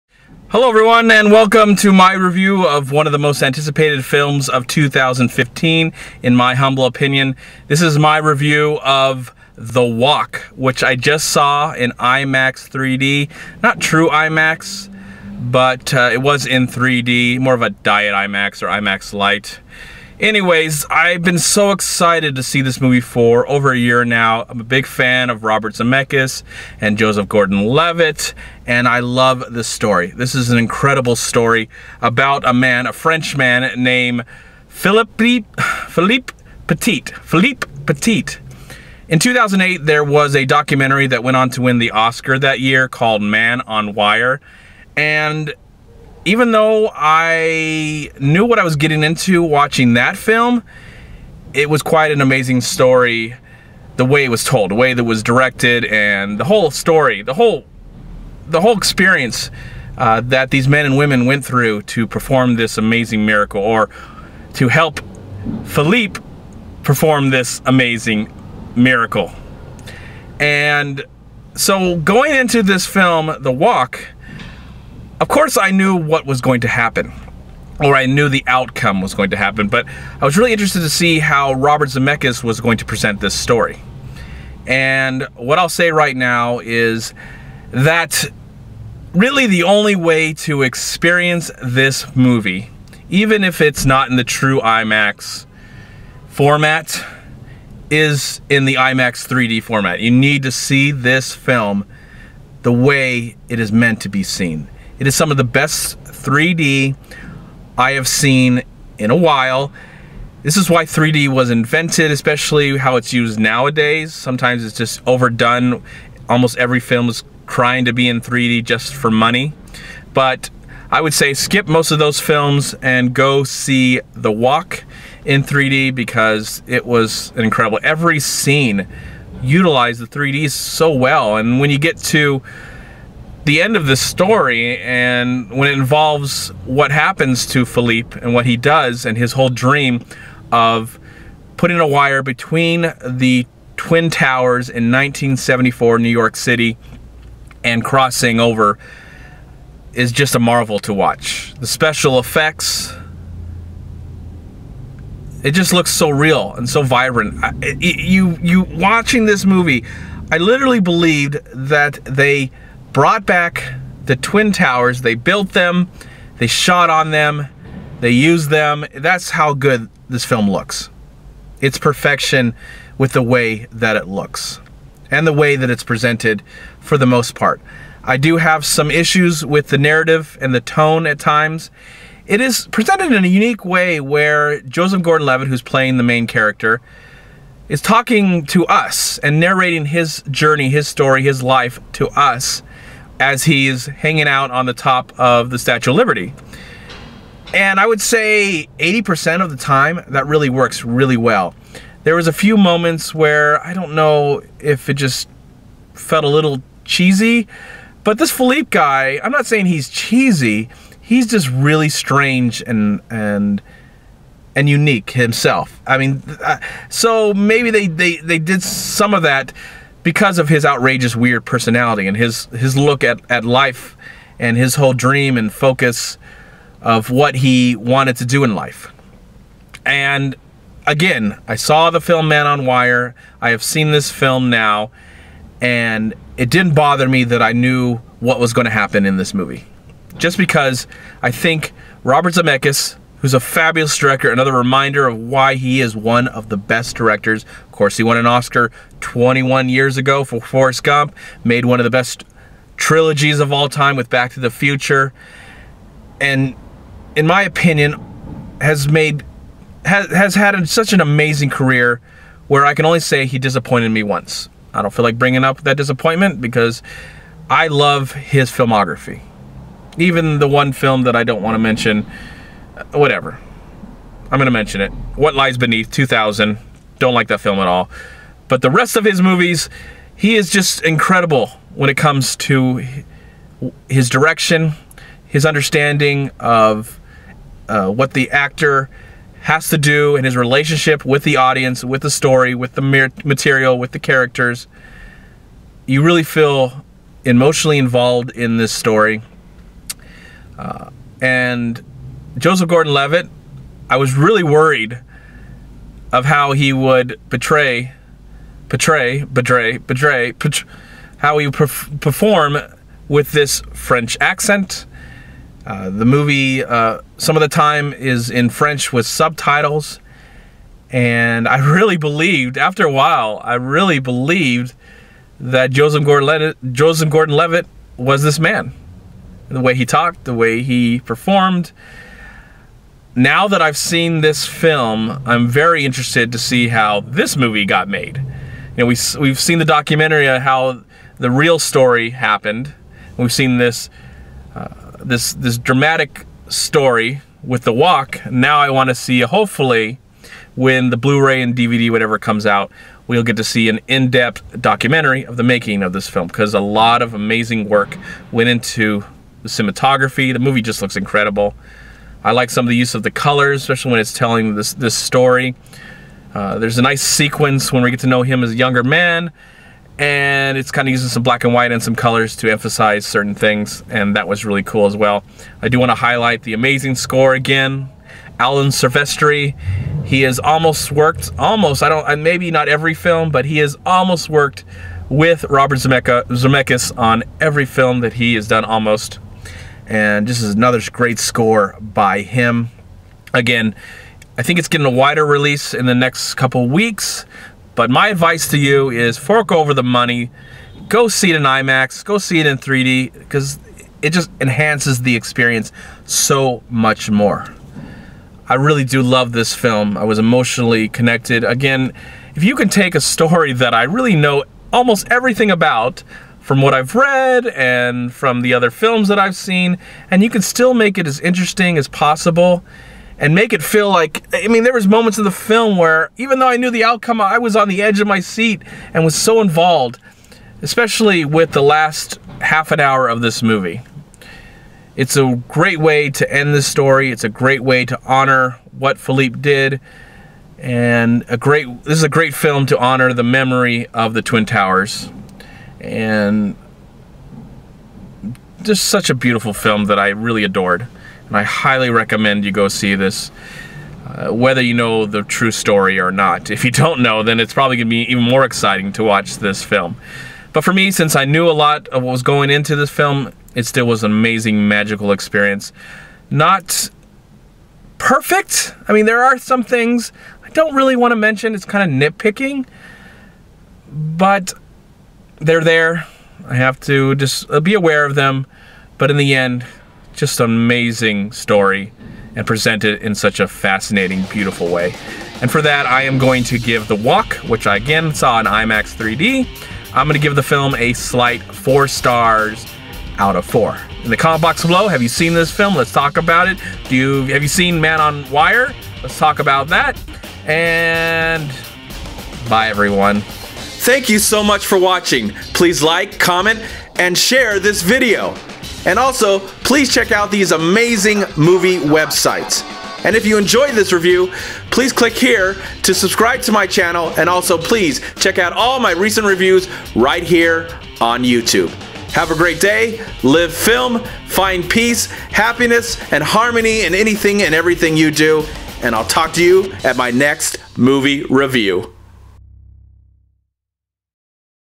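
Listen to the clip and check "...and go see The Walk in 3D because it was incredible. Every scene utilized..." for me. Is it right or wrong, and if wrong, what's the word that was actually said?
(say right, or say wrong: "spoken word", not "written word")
right.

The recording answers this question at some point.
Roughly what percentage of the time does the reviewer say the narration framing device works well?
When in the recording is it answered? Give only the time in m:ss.
3:18.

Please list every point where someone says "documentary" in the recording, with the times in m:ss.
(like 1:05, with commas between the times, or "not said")
0:40, 5:39, 5:54.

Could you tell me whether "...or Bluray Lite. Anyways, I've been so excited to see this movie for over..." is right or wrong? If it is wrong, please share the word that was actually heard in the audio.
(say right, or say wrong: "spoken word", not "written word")
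wrong: "IMAX", not "Bluray".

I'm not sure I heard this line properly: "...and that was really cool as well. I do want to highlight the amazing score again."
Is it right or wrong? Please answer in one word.
right.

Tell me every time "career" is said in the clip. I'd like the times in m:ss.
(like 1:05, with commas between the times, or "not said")
4:21.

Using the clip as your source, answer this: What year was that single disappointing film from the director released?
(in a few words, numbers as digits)
2000.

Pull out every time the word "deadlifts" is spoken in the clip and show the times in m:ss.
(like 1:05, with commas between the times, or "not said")
not said.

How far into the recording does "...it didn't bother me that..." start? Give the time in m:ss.
3:56.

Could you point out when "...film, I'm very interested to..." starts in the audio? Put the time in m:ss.
5:34.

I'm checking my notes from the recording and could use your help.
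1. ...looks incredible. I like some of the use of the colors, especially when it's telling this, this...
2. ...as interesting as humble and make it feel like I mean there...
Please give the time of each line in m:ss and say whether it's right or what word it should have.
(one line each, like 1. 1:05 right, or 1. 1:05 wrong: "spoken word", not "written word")
1. 6:00 right
2. 7:01 wrong: "possible", not "humble".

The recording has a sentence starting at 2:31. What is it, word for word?
The special effects, it just looks so real and so vibrant.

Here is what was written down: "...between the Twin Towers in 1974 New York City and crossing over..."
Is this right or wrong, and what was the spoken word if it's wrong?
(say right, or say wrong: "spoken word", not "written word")
right.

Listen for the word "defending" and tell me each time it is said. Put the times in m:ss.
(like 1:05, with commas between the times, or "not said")
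not said.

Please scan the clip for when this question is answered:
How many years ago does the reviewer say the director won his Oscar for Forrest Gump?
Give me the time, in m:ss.
4:08.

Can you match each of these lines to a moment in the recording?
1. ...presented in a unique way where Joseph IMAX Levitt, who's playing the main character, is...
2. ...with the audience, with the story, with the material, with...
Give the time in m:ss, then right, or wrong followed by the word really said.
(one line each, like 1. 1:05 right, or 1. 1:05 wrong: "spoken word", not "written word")
1. 3:02 wrong: "Gordon", not "IMAX"
2. 4:51 right.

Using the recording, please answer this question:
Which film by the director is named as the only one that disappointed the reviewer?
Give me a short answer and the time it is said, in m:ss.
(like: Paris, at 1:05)
What Lies Beneath, at 4:35.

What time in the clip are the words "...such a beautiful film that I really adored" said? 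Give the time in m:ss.
7:28.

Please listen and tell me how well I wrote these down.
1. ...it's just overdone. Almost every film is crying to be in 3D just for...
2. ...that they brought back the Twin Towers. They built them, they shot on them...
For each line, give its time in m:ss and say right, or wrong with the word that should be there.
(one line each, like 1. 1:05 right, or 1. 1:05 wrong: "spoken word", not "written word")
1. 1:54 right
2. 2:41 right.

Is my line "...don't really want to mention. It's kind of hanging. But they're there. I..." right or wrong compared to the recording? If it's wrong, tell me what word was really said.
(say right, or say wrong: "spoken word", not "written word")
wrong: "nitpicking", not "hanging".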